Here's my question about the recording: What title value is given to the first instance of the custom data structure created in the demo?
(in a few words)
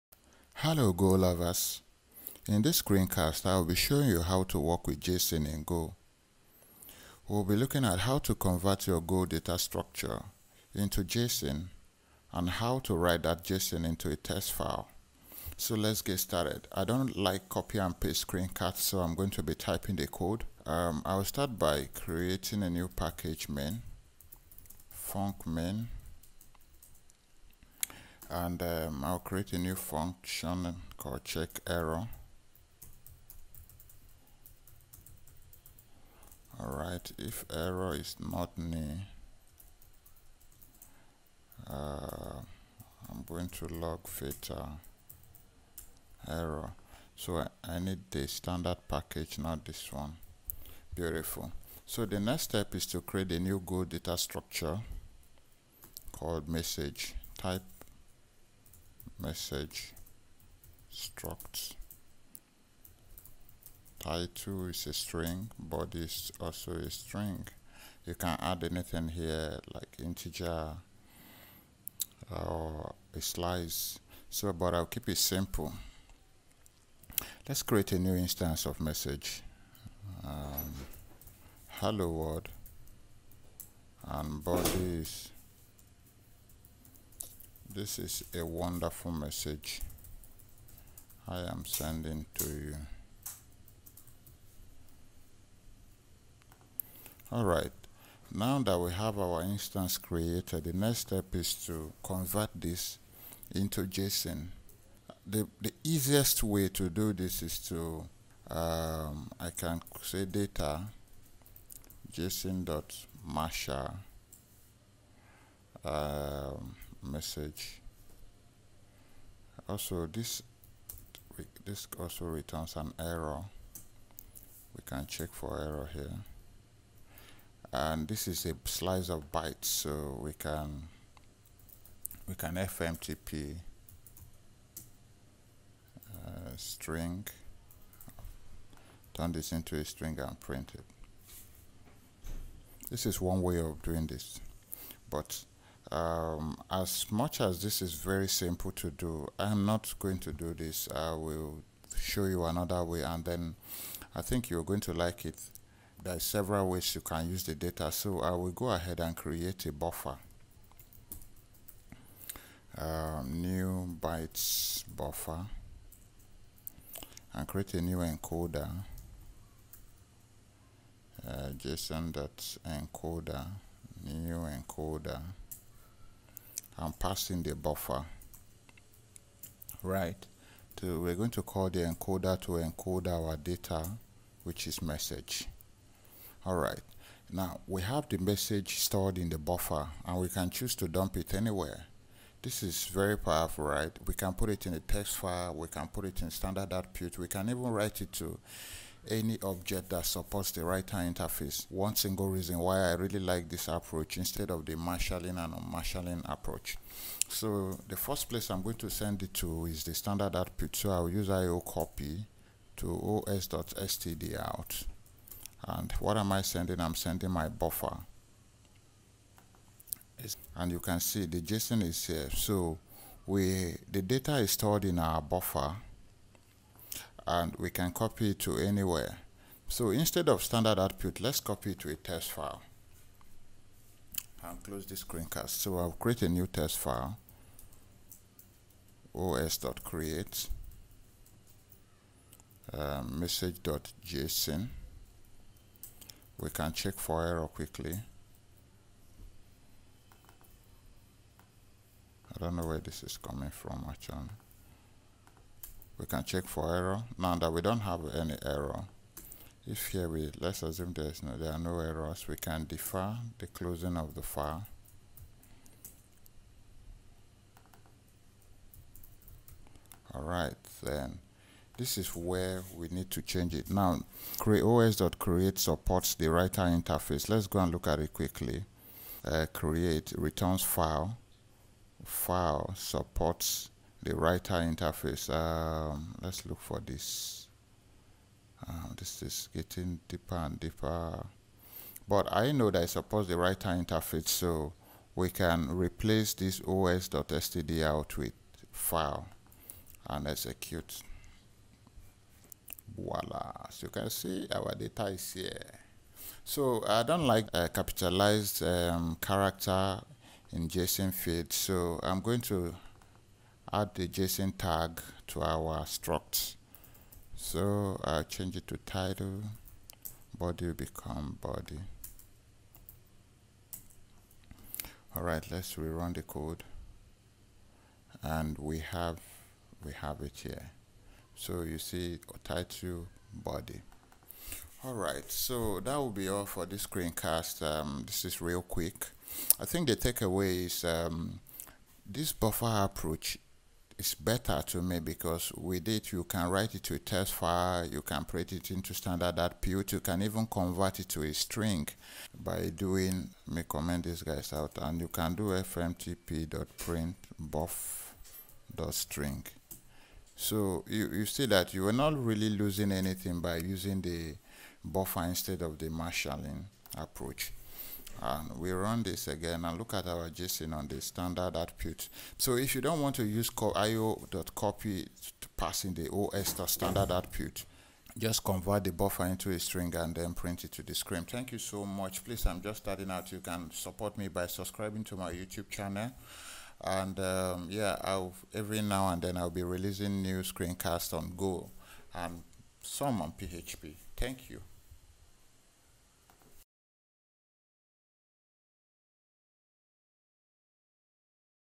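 hello world.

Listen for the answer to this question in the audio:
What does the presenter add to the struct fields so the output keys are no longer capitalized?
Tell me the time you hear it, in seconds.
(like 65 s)
314 s.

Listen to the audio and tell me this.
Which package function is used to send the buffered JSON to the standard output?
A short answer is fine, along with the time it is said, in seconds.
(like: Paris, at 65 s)
IO copy, at 211 s.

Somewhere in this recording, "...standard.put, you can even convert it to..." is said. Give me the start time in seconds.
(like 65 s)
349 s.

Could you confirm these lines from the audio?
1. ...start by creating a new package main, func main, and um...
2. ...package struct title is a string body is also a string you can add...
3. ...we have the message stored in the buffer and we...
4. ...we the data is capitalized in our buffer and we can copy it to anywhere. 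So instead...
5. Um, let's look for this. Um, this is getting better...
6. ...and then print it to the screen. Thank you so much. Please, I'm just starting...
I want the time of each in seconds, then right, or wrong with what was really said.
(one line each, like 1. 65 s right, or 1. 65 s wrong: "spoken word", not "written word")
1. 21 s right
2. 59 s wrong: "message", not "package"
3. 187 s right
4. 223 s wrong: "stored", not "capitalized"
5. 285 s wrong: "deeper", not "better"
6. 379 s right.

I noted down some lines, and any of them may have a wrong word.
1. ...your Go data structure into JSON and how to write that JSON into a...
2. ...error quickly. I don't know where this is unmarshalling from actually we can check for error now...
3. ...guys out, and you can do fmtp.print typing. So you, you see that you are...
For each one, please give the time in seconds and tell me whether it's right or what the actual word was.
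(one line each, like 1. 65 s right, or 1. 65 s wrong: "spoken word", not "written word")
1. 8 s right
2. 247 s wrong: "coming", not "unmarshalling"
3. 354 s wrong: "string", not "typing".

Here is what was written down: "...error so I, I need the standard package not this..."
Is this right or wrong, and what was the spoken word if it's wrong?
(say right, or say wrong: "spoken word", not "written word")
right.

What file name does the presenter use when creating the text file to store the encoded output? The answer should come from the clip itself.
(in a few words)
message.json.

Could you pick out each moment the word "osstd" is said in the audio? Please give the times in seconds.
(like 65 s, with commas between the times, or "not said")
213 s, 296 s.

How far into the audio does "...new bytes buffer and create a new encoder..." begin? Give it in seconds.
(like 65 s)
163 s.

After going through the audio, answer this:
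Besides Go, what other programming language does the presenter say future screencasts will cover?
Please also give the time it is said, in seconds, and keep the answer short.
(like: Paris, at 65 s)
PHP, at 393 s.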